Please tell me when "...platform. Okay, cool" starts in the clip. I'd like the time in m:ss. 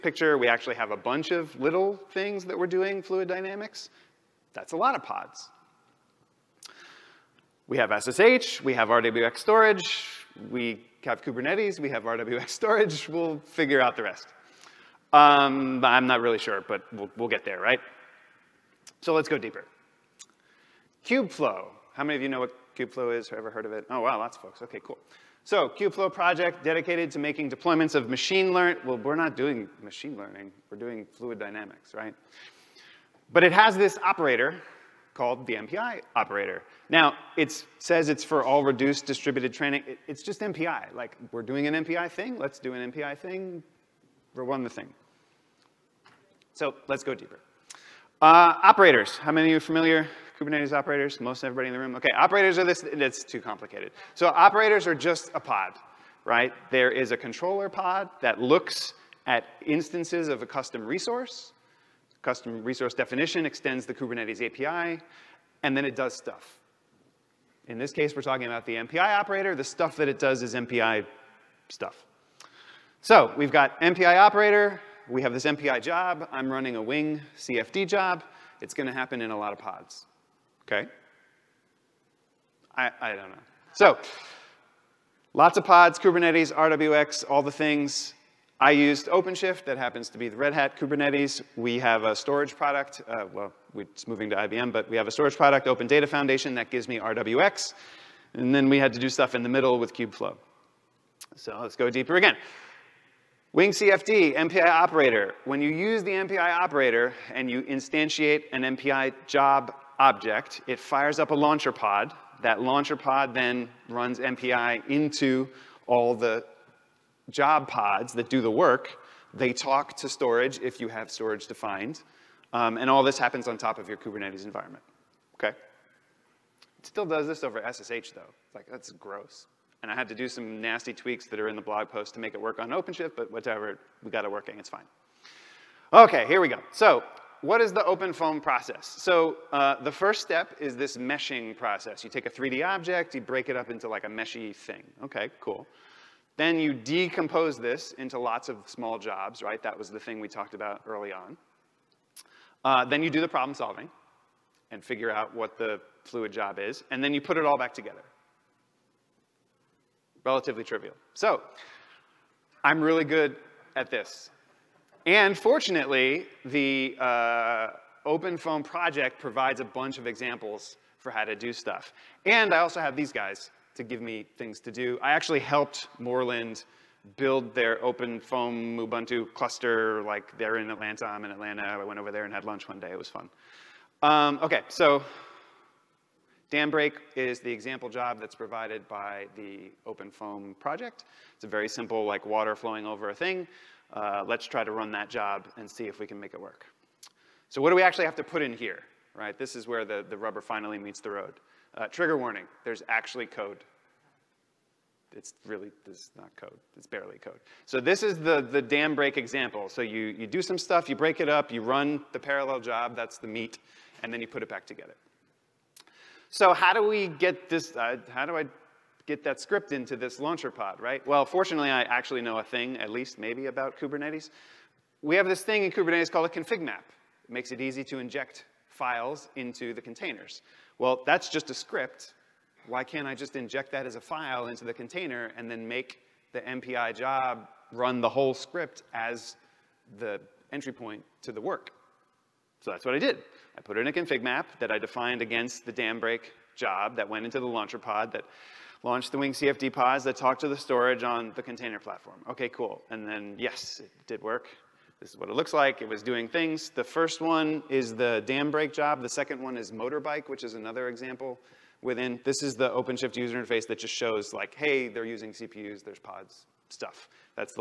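4:11.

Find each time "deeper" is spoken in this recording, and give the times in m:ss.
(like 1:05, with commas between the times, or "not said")
0:19, 0:47, 1:41.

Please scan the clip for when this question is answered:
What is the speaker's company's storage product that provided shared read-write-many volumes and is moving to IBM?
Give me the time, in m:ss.
1:35.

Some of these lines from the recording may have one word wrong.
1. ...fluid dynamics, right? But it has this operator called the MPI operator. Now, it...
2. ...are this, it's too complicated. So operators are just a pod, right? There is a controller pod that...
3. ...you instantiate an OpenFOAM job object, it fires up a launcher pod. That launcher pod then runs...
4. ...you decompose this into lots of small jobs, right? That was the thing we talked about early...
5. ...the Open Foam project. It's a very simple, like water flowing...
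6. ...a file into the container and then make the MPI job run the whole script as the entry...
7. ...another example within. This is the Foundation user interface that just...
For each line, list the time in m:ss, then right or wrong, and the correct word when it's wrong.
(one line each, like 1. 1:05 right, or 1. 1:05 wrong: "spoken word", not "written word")
1. 0:31 right
2. 0:52 right
3. 1:47 wrong: "MPI", not "OpenFOAM"
4. 2:26 right
5. 3:09 right
6. 3:53 right
7. 4:20 wrong: "OpenShift", not "Foundation".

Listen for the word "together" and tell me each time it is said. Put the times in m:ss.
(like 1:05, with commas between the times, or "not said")
2:37, 3:34.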